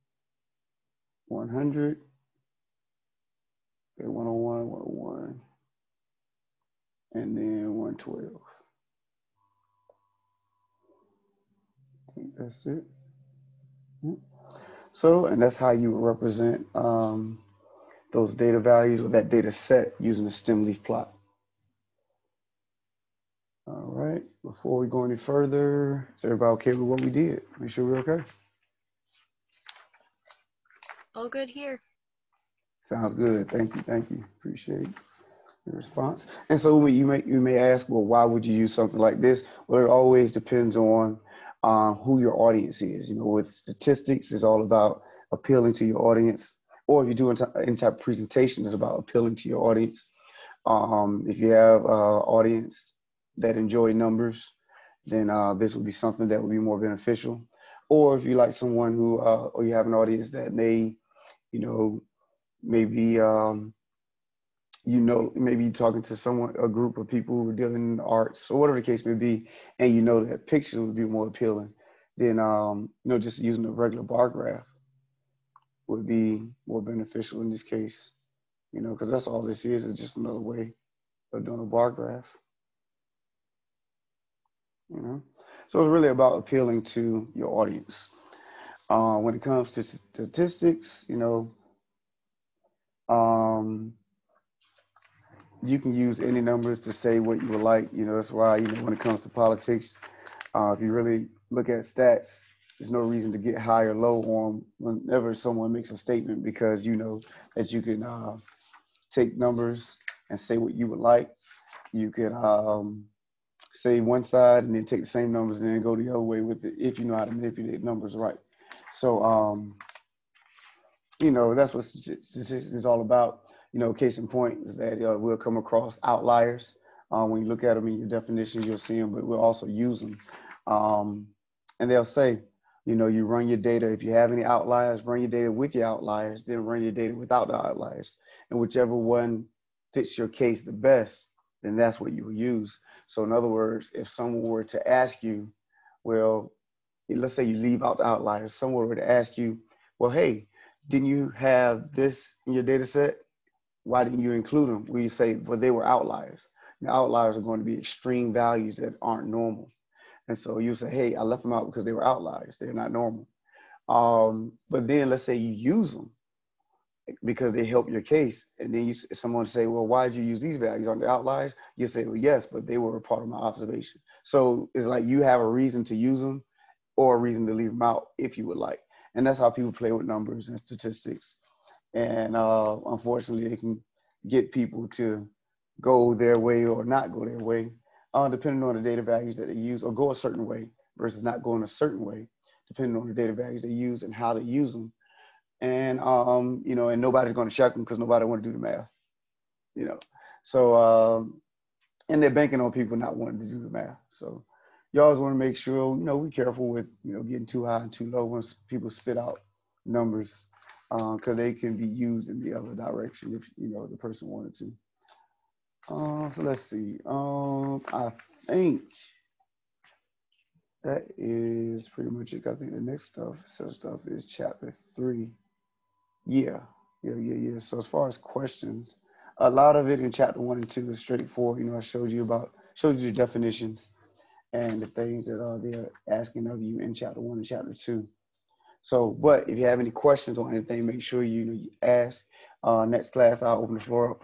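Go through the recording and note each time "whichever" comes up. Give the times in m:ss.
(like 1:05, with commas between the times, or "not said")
2:18.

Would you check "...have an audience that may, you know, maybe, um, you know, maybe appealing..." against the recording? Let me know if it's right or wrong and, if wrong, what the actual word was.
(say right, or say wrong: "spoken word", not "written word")
wrong: "talking", not "appealing".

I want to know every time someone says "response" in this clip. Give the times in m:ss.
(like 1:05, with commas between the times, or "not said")
0:35.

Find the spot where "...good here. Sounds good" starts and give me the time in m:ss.
0:31.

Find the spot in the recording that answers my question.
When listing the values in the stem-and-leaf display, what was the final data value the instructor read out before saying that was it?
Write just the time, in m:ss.
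0:07.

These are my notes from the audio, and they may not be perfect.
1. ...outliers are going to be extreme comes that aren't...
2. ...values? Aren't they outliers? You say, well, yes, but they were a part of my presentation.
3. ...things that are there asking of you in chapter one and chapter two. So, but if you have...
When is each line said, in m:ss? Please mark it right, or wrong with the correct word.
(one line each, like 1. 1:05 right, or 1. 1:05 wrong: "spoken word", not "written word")
1. 2:36 wrong: "values", not "comes"
2. 2:50 wrong: "observation", not "presentation"
3. 3:54 right.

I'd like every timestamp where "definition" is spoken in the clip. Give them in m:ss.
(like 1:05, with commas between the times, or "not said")
2:08, 3:53.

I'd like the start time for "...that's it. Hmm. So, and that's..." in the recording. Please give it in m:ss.
0:12.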